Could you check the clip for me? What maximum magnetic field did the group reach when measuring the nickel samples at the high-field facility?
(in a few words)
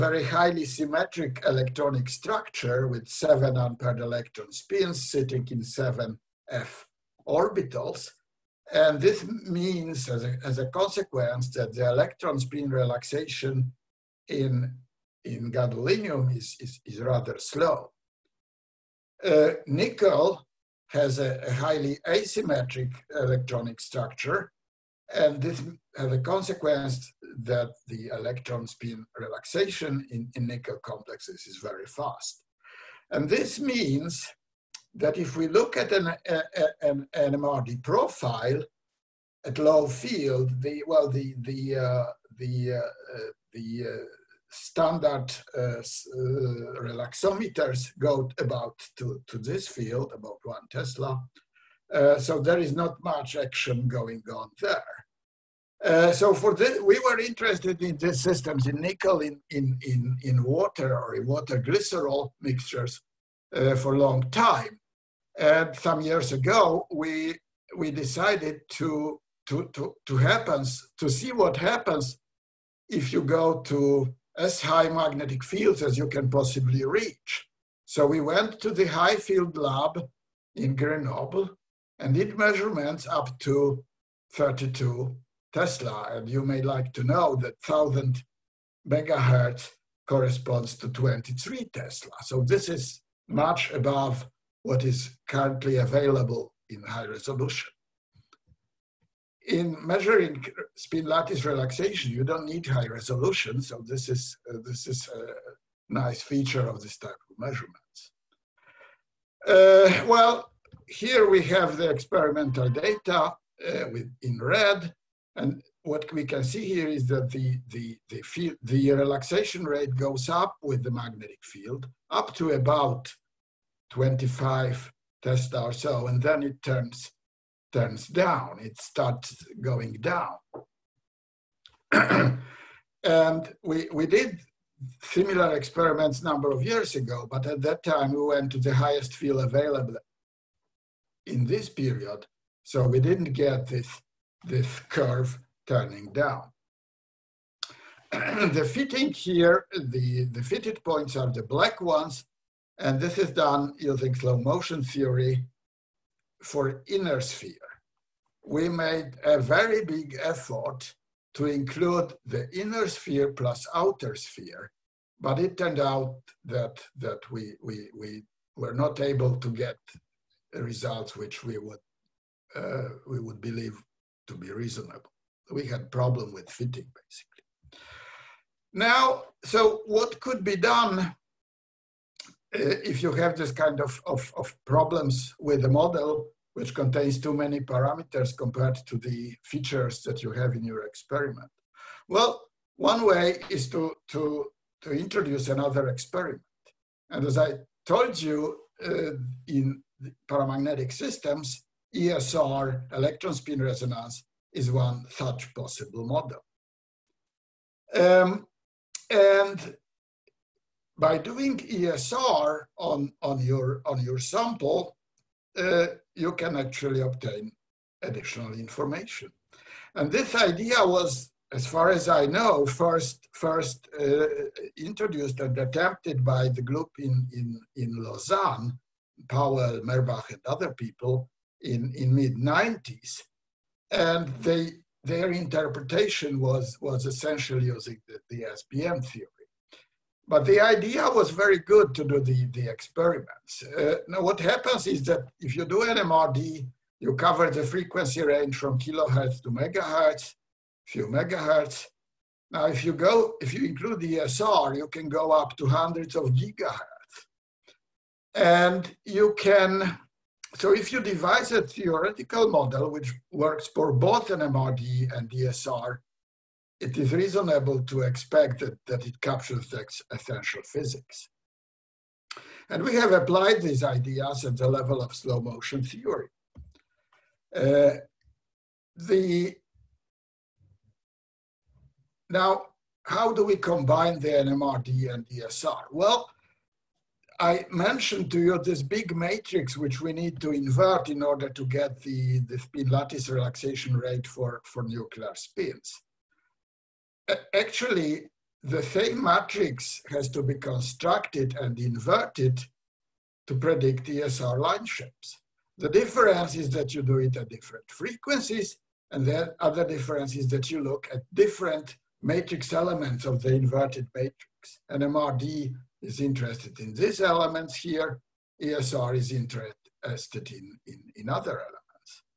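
32 Tesla.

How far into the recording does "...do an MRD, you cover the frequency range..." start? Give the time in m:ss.
4:05.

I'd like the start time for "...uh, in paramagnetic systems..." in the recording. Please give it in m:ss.
3:18.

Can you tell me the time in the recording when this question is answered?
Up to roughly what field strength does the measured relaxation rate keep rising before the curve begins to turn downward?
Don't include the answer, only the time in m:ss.
2:03.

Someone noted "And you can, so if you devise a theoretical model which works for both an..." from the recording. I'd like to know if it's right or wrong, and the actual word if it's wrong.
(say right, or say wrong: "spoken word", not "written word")
right.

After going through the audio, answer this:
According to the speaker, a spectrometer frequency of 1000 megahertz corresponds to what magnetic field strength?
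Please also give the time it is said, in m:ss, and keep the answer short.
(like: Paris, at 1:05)
23 Tesla, at 1:30.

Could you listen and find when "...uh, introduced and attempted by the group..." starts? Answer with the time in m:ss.
3:43.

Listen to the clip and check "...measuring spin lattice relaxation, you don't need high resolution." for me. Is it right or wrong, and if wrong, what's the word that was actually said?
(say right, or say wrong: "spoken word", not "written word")
right.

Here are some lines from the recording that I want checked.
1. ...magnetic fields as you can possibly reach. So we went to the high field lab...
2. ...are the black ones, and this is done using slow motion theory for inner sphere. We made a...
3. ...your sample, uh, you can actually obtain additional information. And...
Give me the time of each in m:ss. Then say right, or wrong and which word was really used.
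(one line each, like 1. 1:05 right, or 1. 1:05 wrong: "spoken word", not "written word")
1. 1:14 right
2. 2:31 right
3. 3:34 right.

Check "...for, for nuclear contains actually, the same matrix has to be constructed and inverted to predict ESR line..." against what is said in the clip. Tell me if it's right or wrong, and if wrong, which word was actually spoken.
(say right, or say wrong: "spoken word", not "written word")
wrong: "spins", not "contains".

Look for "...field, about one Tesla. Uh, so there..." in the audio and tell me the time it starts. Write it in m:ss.
0:49.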